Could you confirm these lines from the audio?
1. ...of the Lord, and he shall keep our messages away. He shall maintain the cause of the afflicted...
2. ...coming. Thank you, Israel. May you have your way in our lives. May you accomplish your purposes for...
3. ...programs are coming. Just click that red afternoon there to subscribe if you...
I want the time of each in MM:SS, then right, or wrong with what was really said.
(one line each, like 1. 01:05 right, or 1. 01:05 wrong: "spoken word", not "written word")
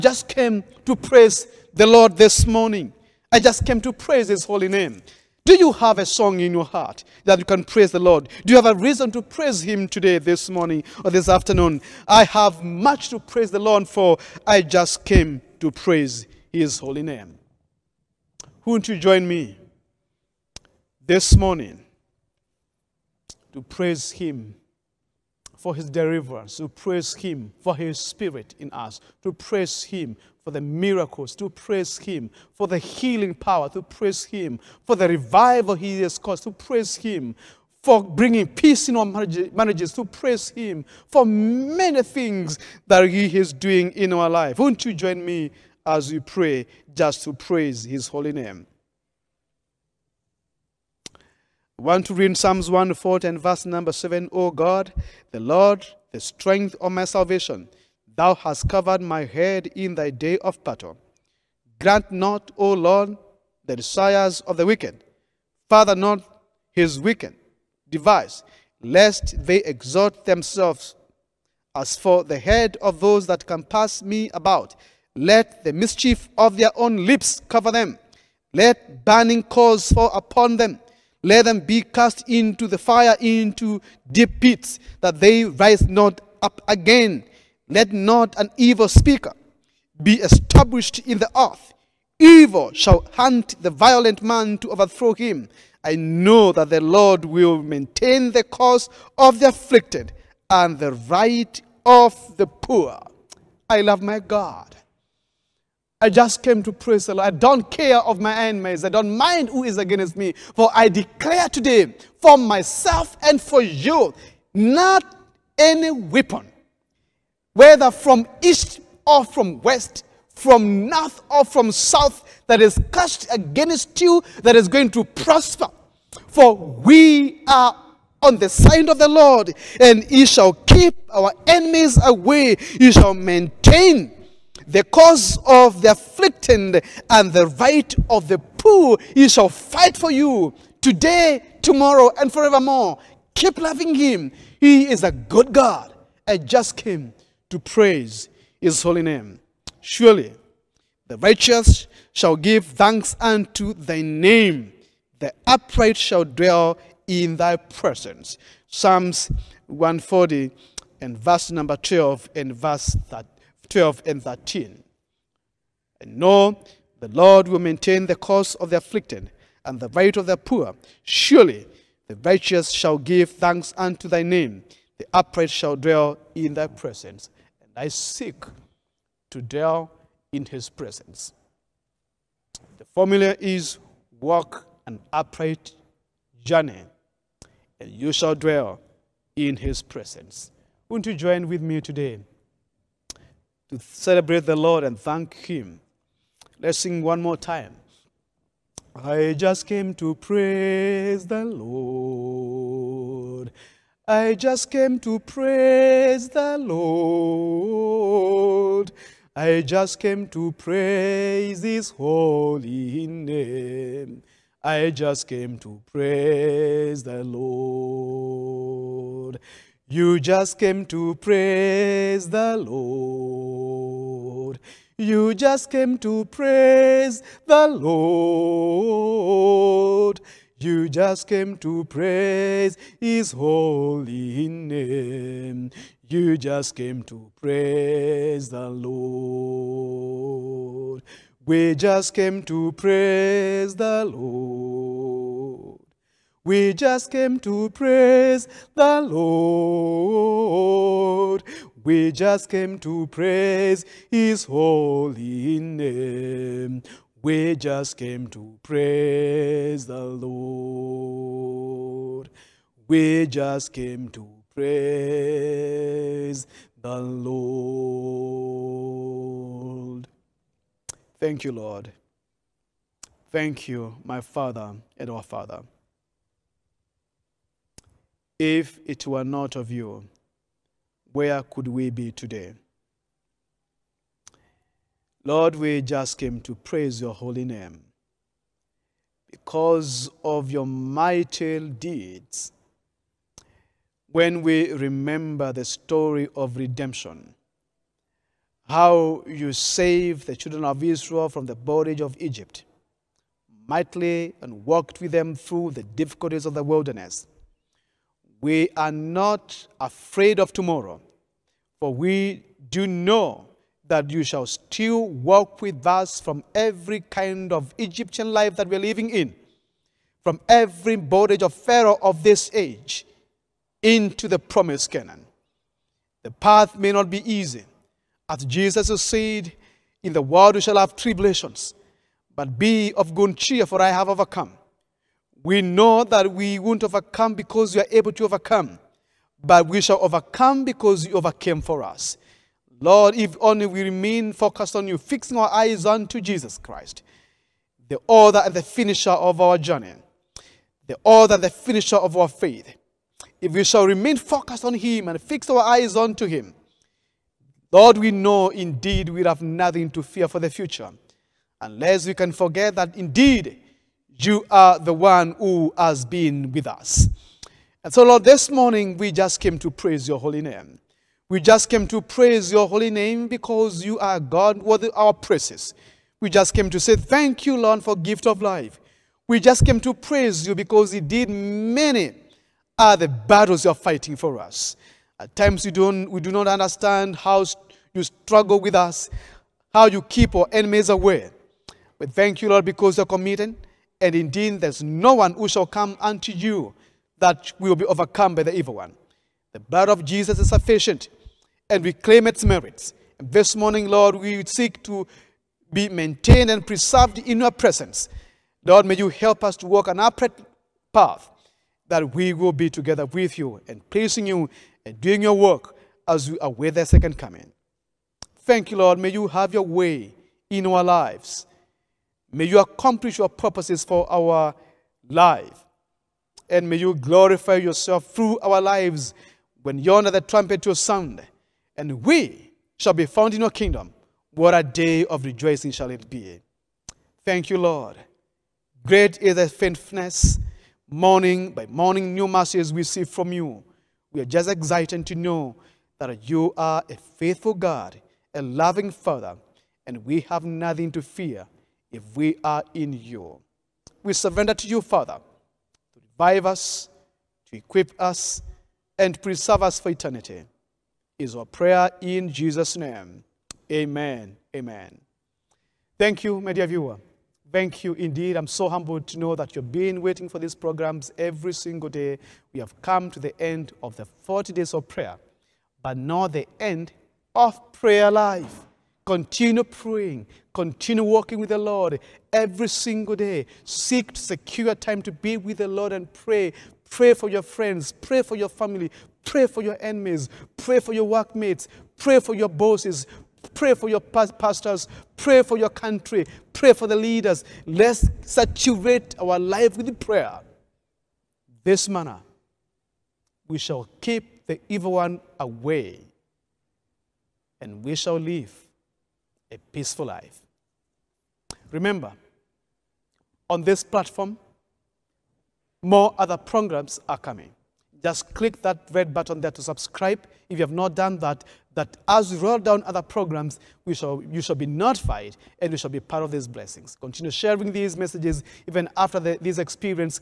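1. 02:08 wrong: "enemies", not "messages"
2. 06:57 wrong: "Lord", not "Israel"
3. 08:36 wrong: "button", not "afternoon".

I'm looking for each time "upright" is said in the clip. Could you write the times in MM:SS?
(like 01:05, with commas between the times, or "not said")
02:35, 02:55, 03:05, 06:49.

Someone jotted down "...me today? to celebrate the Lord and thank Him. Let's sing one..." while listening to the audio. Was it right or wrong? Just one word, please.
right.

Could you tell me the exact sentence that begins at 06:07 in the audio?
And so, Lord, this morning we just came to praise your holy name.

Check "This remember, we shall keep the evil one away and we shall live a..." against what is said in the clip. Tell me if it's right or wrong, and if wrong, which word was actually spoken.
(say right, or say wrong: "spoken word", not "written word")
wrong: "manner", not "remember".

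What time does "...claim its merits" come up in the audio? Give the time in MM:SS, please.
06:41.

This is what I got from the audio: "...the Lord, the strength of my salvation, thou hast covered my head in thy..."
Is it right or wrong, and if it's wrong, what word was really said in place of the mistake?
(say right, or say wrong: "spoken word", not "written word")
right.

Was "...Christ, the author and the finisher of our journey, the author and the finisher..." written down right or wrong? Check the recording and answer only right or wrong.
right.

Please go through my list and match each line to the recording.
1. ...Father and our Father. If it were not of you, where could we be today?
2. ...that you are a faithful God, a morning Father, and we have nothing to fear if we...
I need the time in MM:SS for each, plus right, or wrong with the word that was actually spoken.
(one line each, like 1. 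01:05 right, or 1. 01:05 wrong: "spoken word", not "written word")
1. 04:34 right
2. 07:25 wrong: "loving", not "morning".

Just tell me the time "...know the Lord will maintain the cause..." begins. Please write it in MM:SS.
02:46.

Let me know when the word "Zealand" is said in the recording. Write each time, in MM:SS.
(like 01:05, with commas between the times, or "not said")
not said.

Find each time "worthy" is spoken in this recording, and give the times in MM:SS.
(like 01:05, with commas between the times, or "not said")
06:14.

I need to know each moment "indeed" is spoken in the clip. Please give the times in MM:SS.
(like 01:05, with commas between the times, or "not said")
05:58, 06:02, 06:20, 06:34, 07:47.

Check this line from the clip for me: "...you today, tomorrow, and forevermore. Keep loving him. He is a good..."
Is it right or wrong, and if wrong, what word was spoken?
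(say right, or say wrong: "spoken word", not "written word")
right.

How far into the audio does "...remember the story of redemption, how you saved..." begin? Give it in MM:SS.
04:54.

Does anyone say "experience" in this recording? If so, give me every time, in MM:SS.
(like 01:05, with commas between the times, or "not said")
08:49.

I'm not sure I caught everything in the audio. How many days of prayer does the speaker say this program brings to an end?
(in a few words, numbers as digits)
40.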